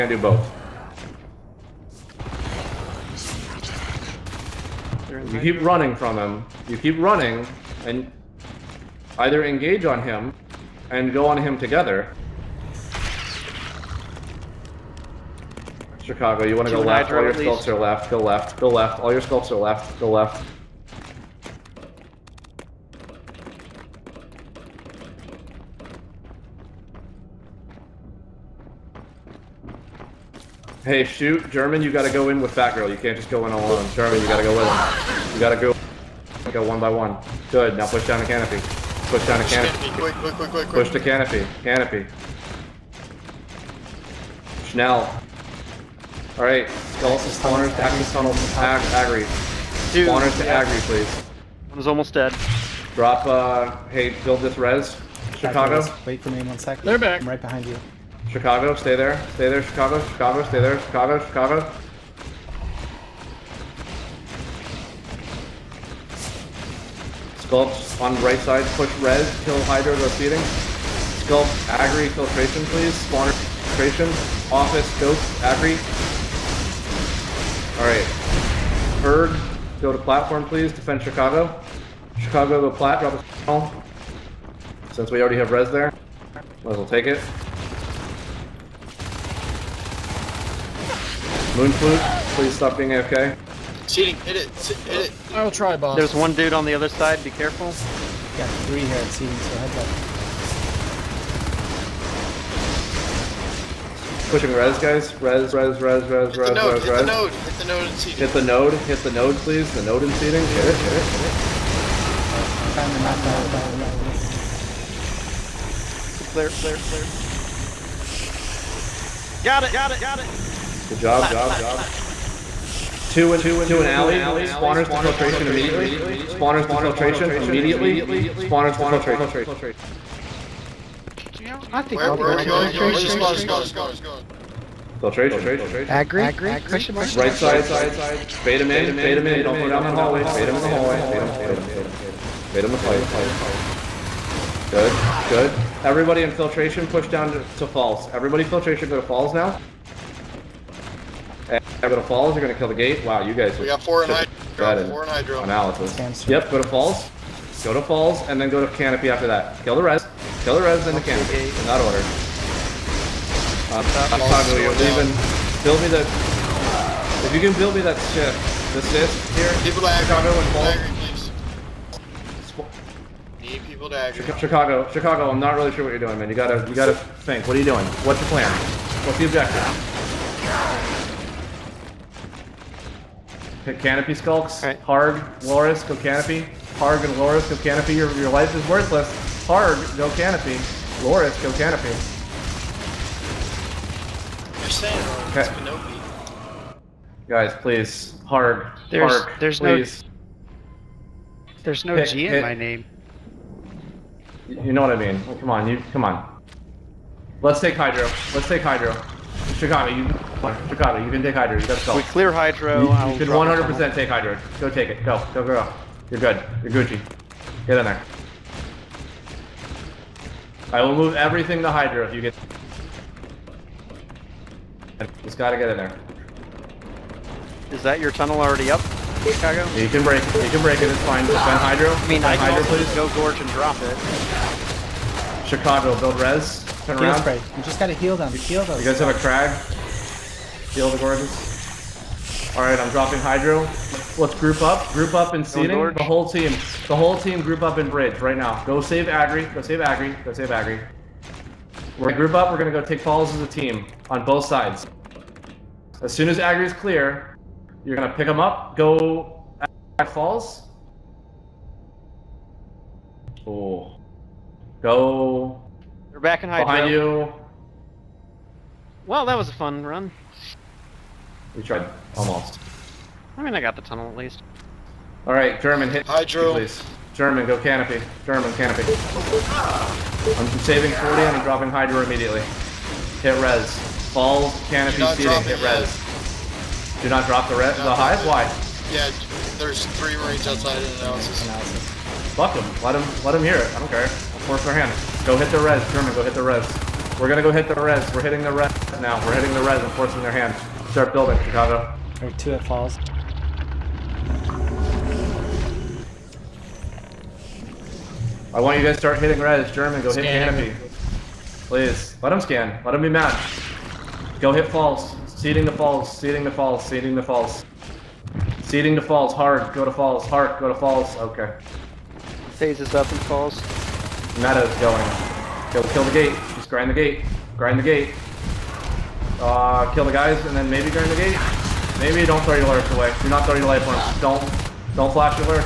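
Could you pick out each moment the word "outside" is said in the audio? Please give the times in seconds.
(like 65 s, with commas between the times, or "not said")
290 s.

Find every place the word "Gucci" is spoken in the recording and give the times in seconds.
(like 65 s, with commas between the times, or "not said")
216 s.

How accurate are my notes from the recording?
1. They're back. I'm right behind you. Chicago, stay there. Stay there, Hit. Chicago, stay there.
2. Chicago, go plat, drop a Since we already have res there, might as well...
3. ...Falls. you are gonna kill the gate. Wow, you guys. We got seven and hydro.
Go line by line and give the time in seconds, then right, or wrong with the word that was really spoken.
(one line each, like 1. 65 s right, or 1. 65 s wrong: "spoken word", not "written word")
1. 56 s wrong: "Chicago", not "Hit"
2. 82 s right
3. 152 s wrong: "four", not "seven".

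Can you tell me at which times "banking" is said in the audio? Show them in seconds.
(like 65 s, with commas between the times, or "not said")
not said.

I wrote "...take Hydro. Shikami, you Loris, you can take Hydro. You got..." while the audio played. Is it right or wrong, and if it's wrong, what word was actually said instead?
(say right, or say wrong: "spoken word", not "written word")
wrong: "Chicago", not "Loris".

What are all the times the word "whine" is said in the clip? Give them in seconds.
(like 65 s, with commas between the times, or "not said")
not said.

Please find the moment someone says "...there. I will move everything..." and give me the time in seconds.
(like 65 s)
217 s.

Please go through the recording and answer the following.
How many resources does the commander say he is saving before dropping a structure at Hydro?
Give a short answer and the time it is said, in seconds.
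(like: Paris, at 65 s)
40, at 278 s.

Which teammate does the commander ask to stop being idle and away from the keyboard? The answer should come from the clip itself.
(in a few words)
Moonflute.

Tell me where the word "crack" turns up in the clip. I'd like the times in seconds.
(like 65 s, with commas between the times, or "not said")
not said.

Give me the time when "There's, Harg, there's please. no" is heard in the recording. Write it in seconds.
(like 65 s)
198 s.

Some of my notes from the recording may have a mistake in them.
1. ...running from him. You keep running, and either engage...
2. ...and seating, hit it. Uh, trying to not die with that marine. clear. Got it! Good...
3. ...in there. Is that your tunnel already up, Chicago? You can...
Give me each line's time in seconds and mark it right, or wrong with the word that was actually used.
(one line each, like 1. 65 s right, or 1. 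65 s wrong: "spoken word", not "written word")
1. 5 s right
2. 110 s right
3. 225 s right.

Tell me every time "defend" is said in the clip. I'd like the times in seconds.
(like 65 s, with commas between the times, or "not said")
80 s, 231 s.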